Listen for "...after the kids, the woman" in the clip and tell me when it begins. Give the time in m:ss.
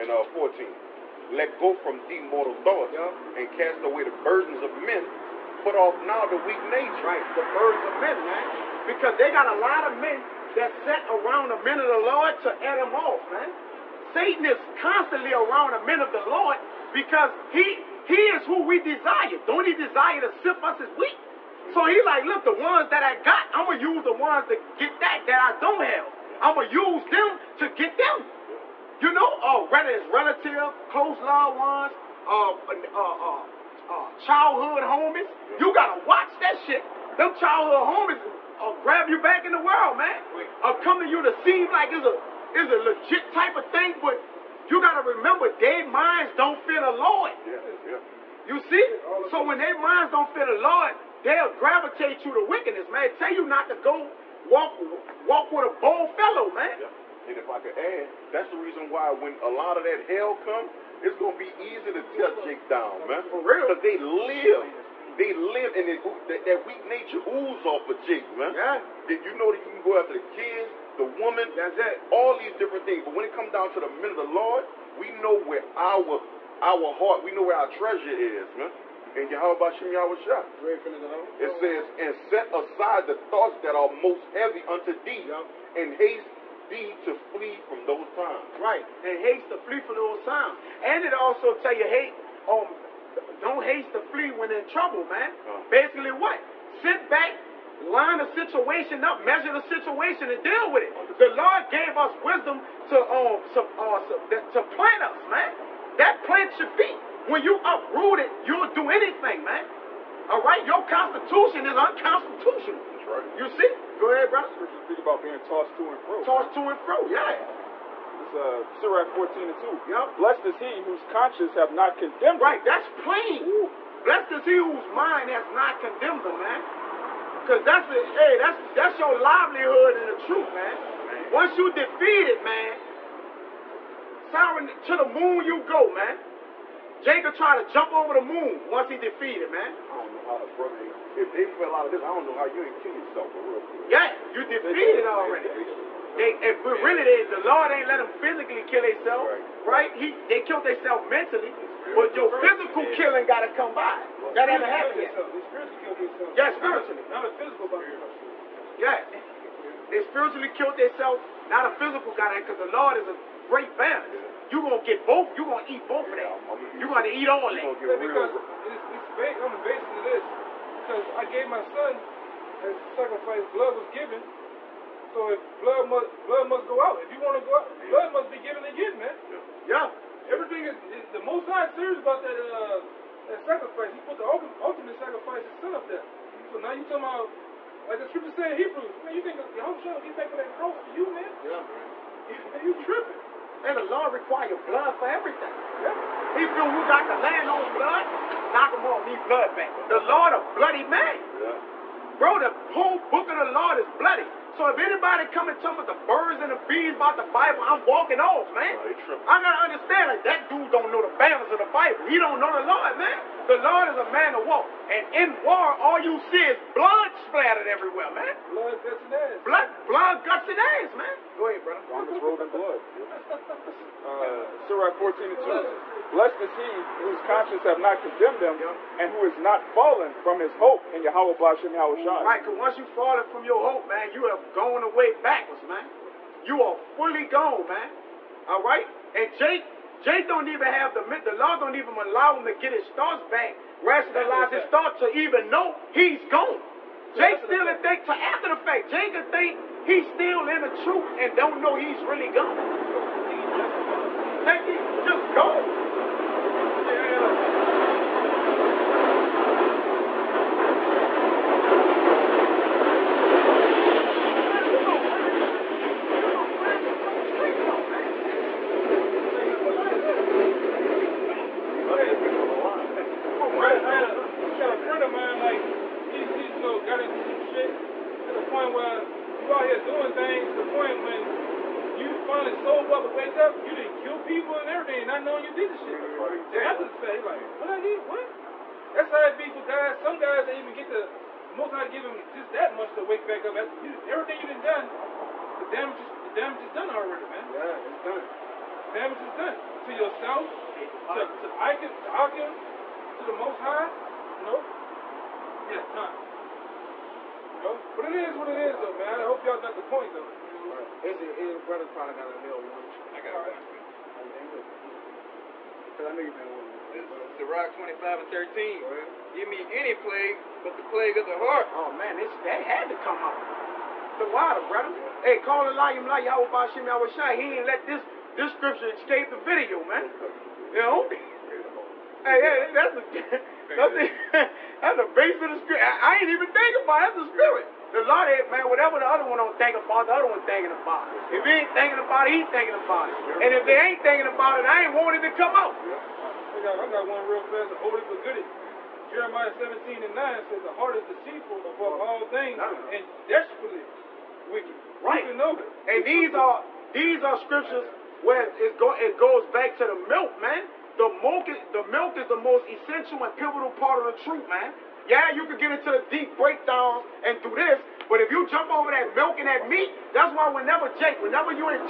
1:09.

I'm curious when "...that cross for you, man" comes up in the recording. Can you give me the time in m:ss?
3:10.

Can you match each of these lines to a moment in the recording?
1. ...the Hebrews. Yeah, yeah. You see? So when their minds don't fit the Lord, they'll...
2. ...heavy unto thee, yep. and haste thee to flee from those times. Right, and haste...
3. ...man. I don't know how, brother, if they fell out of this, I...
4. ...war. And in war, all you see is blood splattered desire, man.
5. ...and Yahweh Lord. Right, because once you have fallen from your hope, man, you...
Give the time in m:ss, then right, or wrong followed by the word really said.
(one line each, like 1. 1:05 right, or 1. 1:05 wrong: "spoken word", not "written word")
1. 0:46 wrong: "Lord", not "Hebrews"
2. 1:24 right
3. 2:19 right
4. 3:34 wrong: "everywhere", not "desire"
5. 3:51 wrong: "Shai", not "Lord".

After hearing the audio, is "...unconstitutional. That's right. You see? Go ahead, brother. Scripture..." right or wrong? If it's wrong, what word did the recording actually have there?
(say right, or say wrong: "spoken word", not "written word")
right.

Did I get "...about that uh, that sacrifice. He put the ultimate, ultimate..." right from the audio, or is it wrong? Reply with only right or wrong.
right.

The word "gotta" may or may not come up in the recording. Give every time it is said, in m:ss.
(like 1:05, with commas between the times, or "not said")
0:35, 3:29.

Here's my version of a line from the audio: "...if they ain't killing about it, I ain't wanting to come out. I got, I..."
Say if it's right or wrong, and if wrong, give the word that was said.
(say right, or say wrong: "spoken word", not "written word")
wrong: "thinking", not "killing".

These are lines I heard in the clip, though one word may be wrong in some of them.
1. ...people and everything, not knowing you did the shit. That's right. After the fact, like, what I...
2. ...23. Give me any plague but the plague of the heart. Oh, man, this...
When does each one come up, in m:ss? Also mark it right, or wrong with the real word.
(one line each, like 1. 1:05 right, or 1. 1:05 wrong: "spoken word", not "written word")
1. 4:44 right
2. 5:18 wrong: "13", not "23".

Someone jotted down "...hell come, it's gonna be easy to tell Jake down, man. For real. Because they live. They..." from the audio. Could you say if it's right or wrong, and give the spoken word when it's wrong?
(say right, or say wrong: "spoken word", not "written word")
right.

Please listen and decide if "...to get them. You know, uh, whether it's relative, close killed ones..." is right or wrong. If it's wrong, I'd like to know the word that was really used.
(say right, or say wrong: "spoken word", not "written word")
wrong: "loved", not "killed".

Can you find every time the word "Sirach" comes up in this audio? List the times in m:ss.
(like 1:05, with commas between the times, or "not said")
1:58, 3:44, 5:17.